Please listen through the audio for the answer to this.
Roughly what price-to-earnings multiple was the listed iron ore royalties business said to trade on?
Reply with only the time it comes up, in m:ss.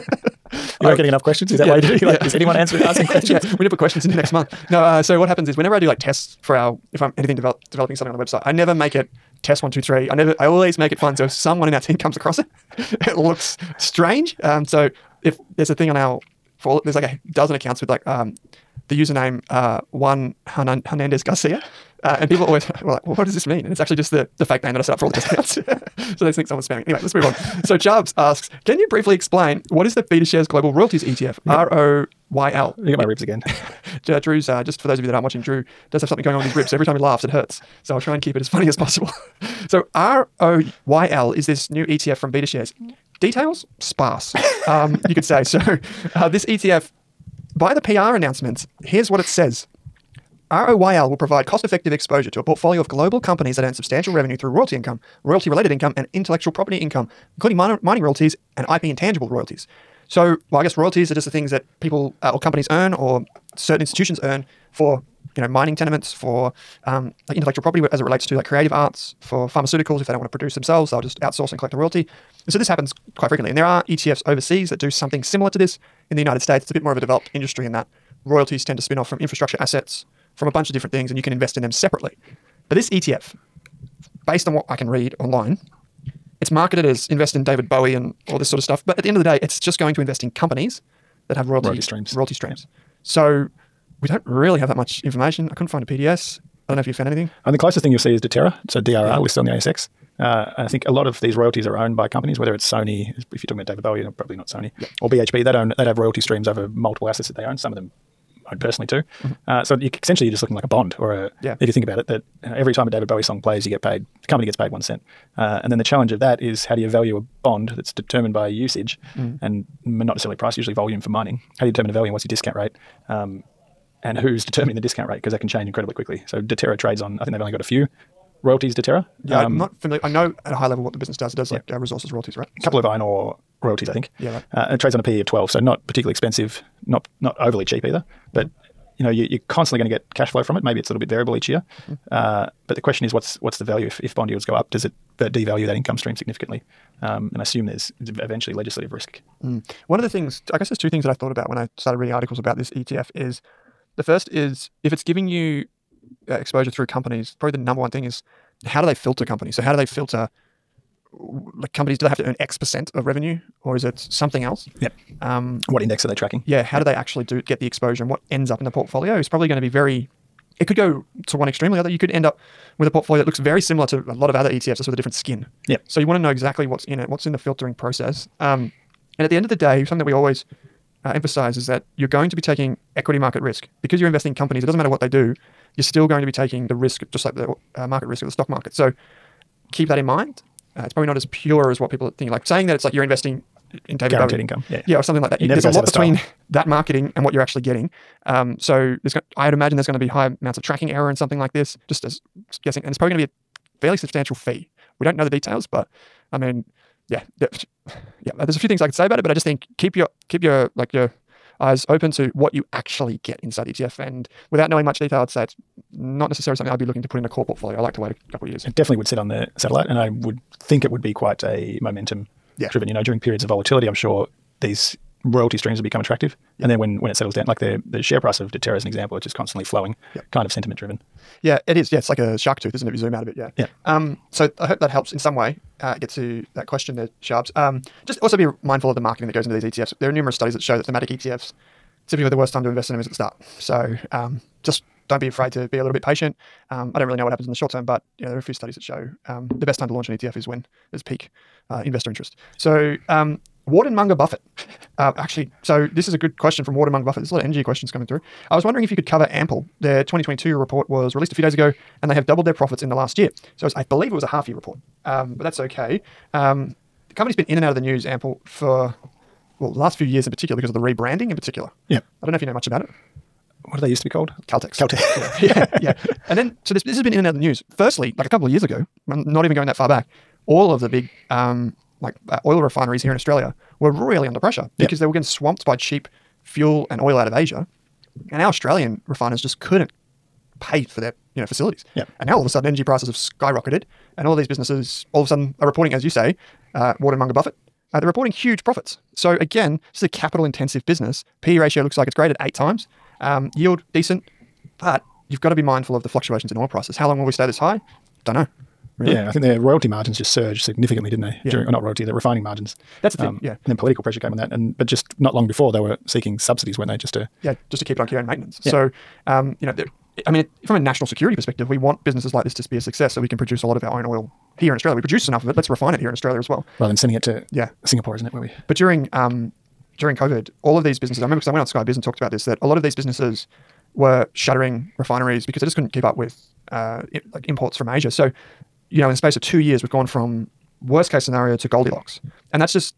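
2:14.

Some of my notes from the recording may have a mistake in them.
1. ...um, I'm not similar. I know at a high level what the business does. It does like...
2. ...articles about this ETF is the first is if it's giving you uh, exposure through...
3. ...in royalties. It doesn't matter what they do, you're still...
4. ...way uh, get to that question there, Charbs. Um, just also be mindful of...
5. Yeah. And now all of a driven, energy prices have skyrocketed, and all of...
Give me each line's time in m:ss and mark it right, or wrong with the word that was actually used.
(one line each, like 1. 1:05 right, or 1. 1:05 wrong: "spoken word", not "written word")
1. 2:09 wrong: "familiar", not "similar"
2. 2:32 right
3. 3:04 wrong: "companies", not "royalties"
4. 3:55 right
5. 4:51 wrong: "sudden", not "driven".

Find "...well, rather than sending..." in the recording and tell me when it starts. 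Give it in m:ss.
5:26.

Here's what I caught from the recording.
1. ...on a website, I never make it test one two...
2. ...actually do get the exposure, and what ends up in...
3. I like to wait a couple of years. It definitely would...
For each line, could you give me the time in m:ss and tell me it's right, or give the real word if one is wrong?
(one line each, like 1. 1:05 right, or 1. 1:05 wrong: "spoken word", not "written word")
1. 0:08 right
2. 2:46 right
3. 3:37 right.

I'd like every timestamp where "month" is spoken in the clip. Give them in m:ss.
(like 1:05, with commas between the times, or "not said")
0:04.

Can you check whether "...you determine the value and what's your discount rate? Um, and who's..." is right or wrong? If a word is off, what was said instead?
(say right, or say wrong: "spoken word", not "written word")
right.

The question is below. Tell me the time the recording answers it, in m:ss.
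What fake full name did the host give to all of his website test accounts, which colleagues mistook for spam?
0:19.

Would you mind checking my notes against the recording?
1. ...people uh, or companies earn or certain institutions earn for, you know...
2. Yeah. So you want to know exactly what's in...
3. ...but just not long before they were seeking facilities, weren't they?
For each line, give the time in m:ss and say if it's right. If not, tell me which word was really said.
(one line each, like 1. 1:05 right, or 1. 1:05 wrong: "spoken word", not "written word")
1. 1:01 right
2. 2:55 right
3. 5:14 wrong: "subsidies", not "facilities".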